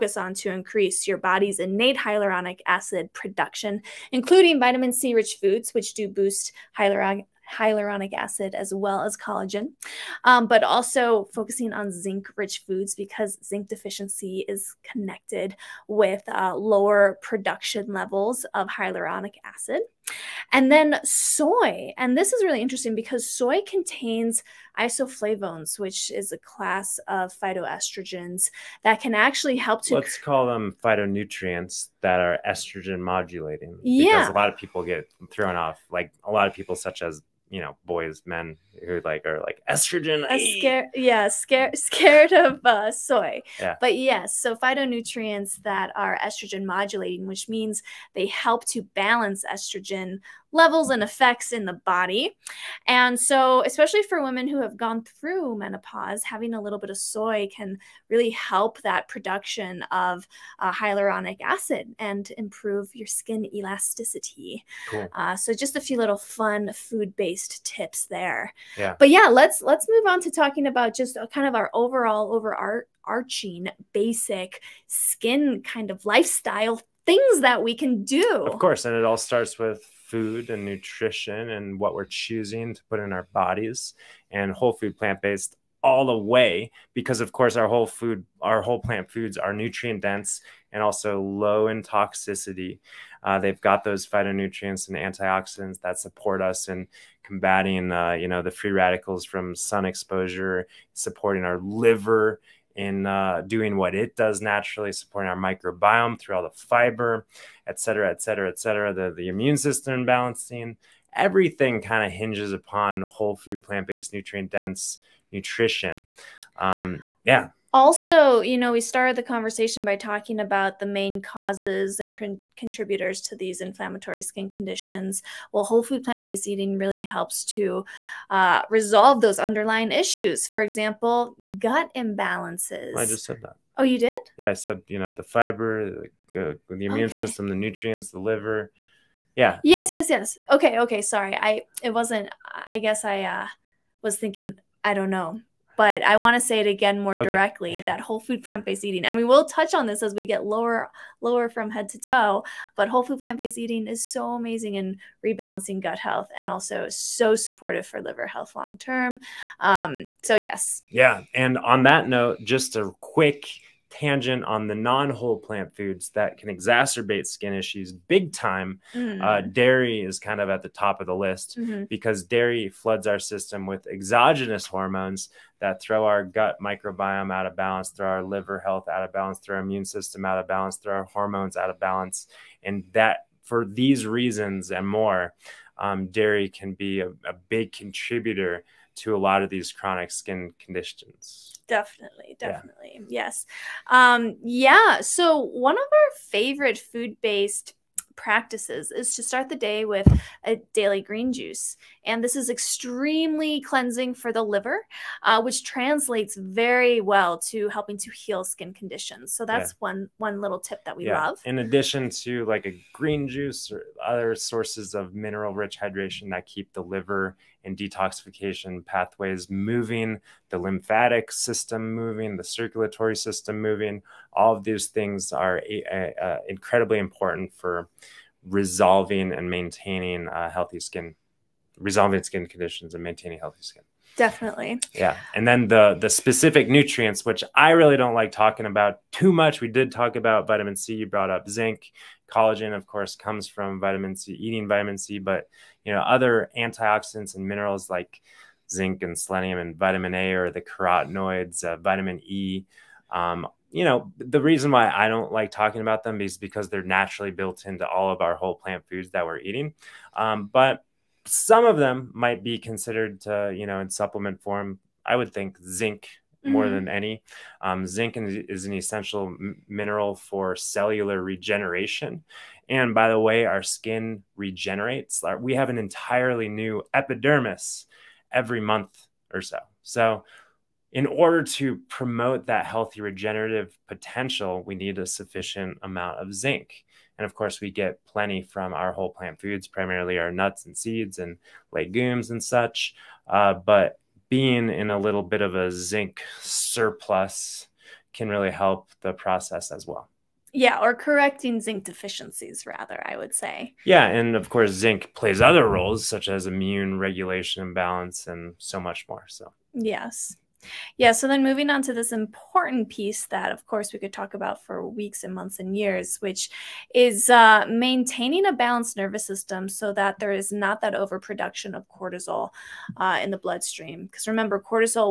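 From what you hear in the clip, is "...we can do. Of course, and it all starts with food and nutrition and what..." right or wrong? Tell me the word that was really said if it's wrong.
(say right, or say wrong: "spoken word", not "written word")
right.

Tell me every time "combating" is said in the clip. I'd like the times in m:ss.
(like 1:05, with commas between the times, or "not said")
1:37.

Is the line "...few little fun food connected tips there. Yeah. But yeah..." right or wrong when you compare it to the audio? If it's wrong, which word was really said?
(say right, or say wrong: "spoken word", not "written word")
wrong: "based", not "connected".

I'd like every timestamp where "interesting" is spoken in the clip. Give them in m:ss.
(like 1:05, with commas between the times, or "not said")
0:22.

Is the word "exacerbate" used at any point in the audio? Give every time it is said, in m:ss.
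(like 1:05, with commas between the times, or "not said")
2:46.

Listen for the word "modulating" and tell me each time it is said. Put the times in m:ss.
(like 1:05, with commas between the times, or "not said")
0:32, 0:46.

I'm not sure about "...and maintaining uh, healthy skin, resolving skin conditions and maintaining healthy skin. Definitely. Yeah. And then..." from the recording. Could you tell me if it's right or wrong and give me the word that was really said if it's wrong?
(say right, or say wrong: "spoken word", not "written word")
right.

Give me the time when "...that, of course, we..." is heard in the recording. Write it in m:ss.
5:13.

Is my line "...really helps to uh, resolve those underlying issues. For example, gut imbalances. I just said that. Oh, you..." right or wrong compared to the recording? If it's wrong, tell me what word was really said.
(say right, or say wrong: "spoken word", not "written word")
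right.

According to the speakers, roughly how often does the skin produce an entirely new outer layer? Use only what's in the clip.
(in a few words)
Every month.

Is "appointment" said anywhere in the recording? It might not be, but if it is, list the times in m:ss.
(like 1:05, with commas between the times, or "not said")
not said.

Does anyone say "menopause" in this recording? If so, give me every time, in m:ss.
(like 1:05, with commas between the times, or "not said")
0:55.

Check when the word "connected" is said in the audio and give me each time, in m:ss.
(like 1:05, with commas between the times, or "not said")
0:14.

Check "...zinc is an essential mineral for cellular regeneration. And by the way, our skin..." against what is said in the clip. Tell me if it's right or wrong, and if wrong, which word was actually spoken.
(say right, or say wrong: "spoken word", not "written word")
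right.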